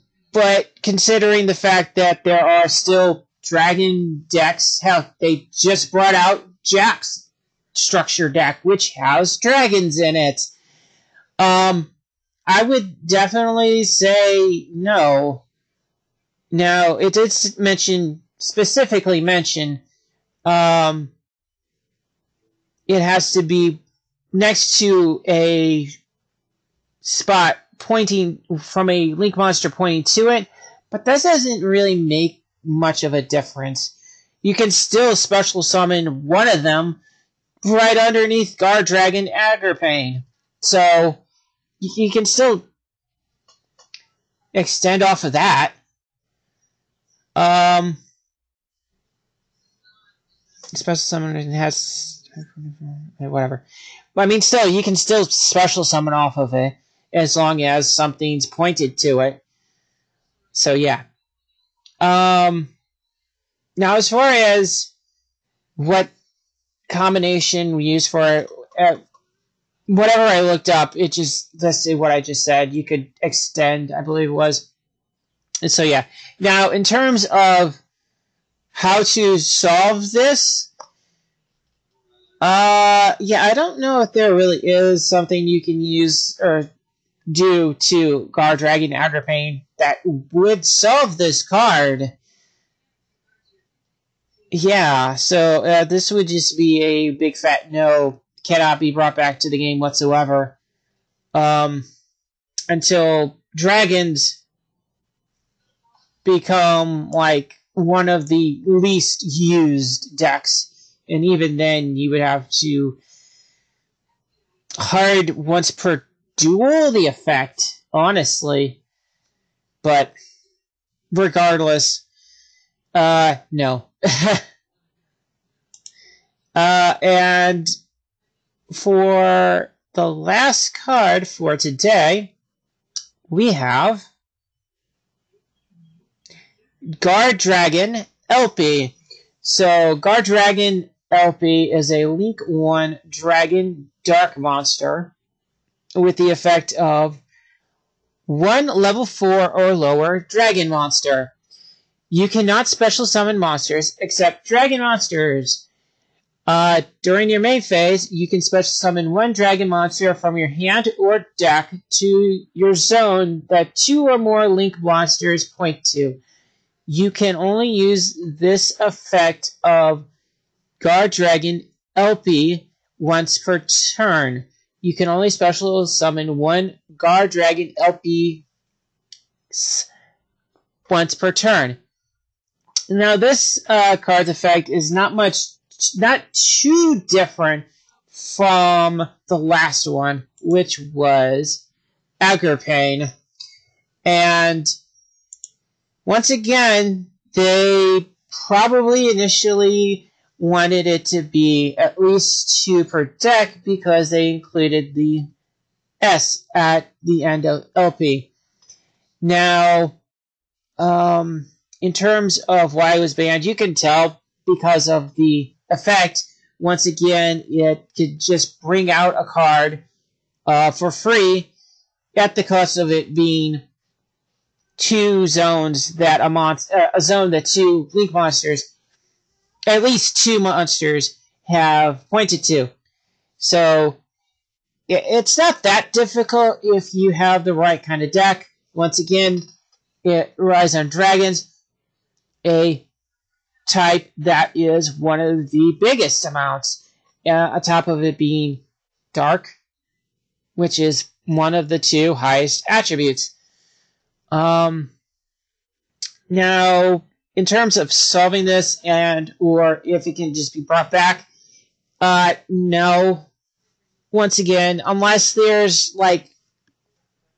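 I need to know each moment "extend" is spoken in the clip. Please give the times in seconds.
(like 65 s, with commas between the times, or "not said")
44 s, 73 s.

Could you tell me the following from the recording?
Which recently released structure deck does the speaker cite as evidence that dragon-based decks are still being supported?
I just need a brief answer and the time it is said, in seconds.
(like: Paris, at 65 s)
Jax structure deck, at 6 s.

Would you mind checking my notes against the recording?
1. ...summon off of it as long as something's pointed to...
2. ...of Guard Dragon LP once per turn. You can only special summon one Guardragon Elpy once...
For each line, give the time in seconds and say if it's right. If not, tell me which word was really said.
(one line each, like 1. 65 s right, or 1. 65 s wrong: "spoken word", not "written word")
1. 55 s right
2. 169 s right.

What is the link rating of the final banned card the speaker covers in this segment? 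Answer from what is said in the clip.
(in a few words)
Link 1.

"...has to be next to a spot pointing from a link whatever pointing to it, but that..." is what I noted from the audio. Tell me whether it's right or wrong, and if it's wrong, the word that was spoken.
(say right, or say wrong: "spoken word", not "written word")
wrong: "monster", not "whatever".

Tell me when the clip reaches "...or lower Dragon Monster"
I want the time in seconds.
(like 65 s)
149 s.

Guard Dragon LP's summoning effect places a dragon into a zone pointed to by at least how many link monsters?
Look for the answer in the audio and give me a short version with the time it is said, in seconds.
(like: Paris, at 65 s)
2, at 163 s.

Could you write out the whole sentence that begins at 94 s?
Yeah, so uh, this would just be a big fat no, cannot be brought back to the game whatsoever.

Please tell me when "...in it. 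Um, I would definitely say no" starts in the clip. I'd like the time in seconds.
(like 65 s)
9 s.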